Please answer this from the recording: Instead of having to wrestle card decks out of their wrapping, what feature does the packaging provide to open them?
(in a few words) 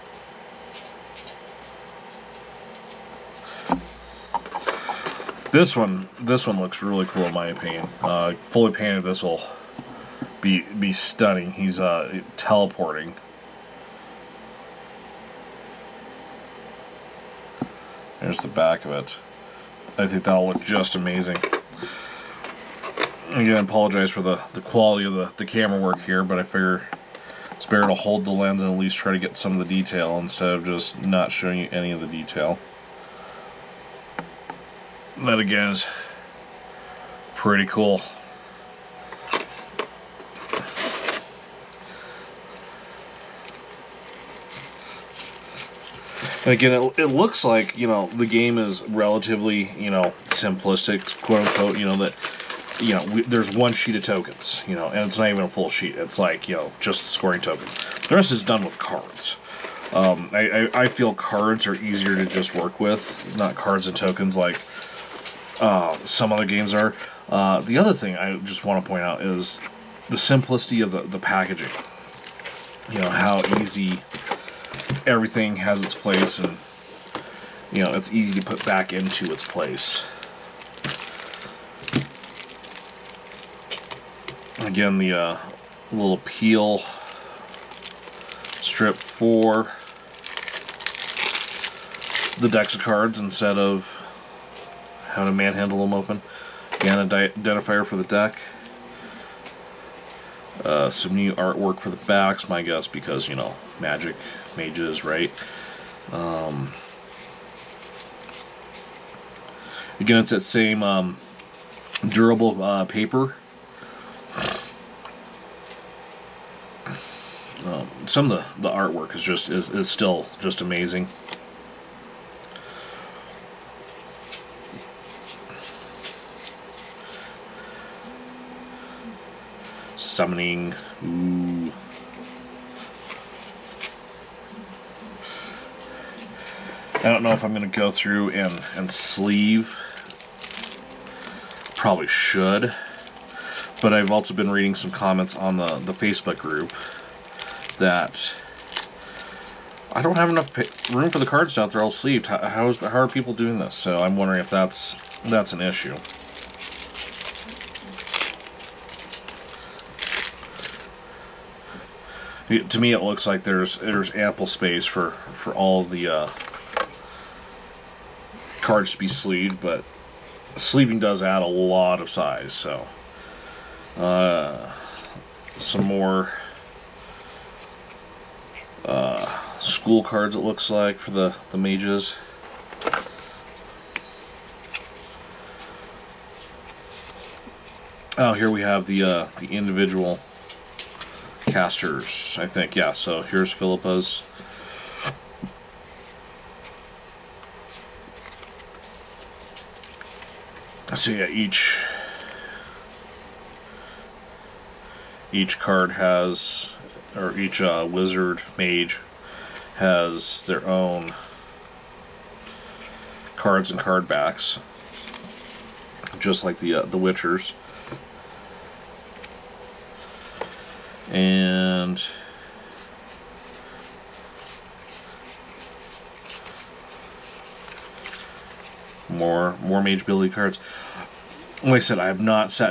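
Peel strip.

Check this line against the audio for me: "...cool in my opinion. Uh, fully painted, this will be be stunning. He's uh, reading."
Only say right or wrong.
wrong.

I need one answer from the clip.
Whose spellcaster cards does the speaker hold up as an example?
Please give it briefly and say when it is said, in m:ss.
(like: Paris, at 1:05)
Philippa, at 3:13.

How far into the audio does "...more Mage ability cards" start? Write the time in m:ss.
3:49.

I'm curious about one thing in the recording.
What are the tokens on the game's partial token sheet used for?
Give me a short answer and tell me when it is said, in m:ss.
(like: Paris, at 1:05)
Scoring, at 0:57.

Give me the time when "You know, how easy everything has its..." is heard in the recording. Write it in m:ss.
1:12.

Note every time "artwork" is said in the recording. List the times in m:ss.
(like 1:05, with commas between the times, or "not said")
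1:41, 1:58.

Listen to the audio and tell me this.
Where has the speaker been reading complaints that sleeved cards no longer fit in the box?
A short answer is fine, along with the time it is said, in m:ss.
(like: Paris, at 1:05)
Facebook group, at 2:25.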